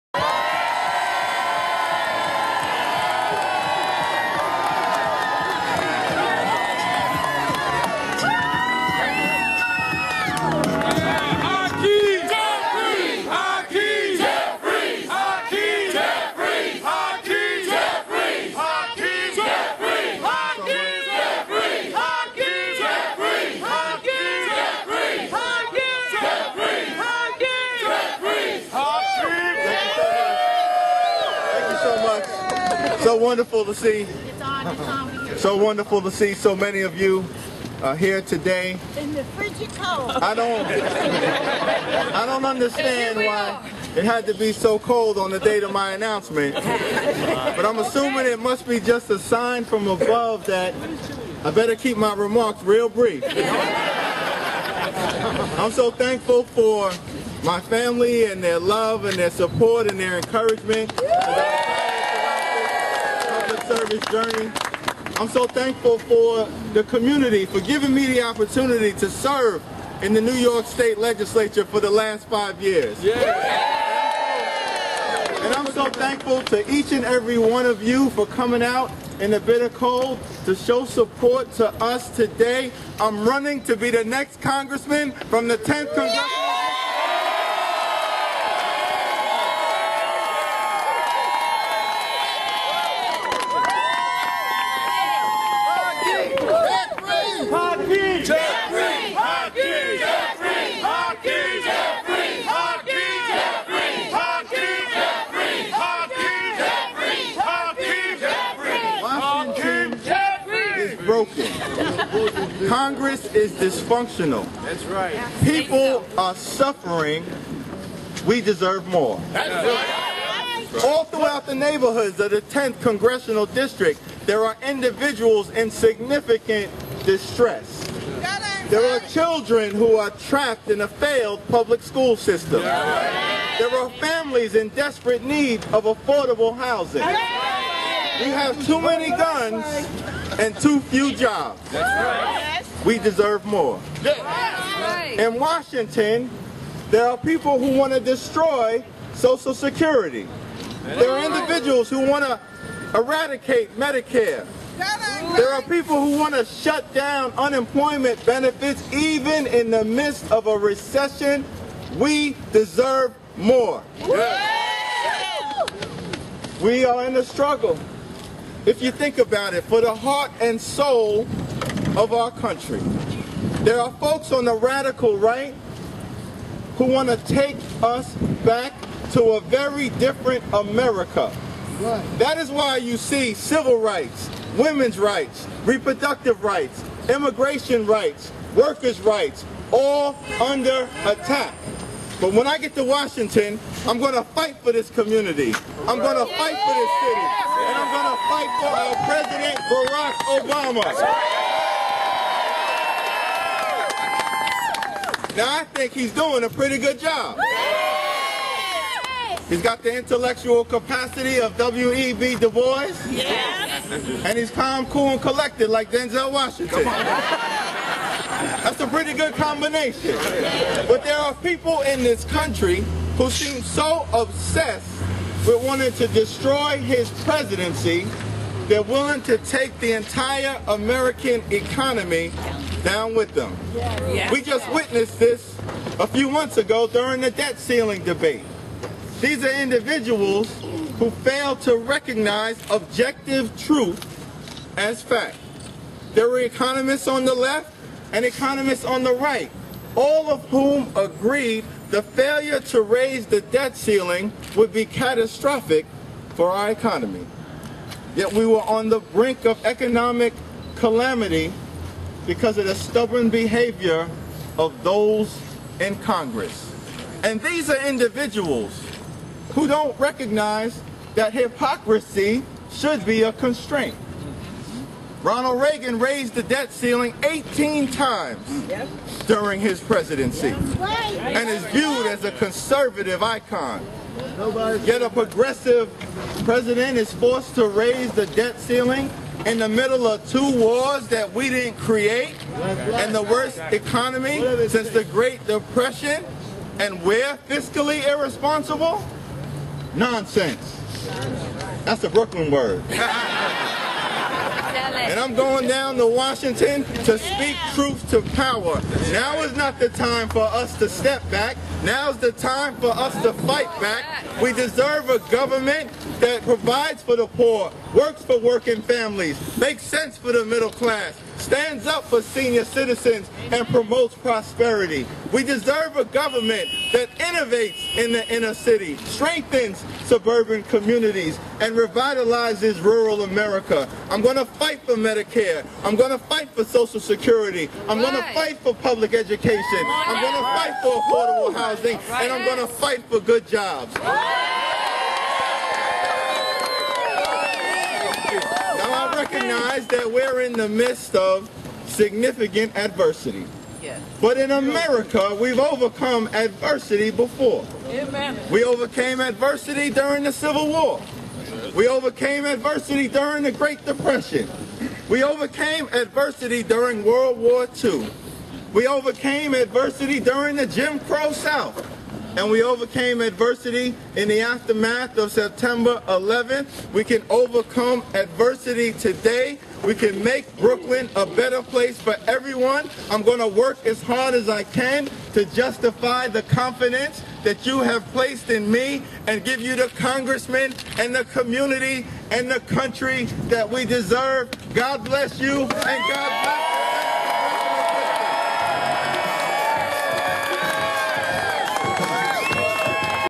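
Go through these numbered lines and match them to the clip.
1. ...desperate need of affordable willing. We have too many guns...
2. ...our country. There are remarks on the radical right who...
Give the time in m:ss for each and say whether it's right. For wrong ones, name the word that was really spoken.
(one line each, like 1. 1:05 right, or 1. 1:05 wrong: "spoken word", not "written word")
1. 2:14 wrong: "housing", not "willing"
2. 2:52 wrong: "folks", not "remarks".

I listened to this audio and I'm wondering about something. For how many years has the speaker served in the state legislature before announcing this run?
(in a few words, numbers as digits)
5 years.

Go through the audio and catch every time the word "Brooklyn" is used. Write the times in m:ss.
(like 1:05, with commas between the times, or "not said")
5:02, 6:20.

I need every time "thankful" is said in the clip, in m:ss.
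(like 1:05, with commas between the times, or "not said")
0:55, 1:05, 1:15.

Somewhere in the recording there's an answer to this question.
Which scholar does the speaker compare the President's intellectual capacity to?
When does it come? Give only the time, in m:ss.
3:31.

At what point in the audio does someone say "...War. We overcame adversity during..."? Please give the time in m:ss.
6:00.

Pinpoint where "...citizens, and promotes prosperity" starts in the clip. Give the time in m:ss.
5:22.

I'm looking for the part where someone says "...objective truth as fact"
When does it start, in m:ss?
4:02.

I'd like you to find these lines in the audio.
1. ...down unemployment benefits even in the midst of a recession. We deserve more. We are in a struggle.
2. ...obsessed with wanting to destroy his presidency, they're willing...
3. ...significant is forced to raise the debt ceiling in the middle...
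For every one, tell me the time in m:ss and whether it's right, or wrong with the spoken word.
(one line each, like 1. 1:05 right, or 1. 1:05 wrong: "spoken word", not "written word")
1. 2:36 right
2. 3:44 right
3. 4:46 wrong: "president", not "significant".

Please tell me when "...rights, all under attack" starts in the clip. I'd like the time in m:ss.
3:09.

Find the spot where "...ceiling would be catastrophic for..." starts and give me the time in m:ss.
4:13.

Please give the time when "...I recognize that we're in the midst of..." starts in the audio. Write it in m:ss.
5:48.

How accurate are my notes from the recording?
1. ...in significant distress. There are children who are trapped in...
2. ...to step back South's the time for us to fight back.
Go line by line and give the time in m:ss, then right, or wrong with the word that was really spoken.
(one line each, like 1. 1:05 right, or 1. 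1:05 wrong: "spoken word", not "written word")
1. 2:05 right
2. 5:10 wrong: "Now", not "South".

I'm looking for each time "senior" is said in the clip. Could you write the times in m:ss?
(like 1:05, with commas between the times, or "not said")
5:22.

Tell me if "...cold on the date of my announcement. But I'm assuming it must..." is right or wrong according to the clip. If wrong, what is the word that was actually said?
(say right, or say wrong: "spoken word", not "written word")
right.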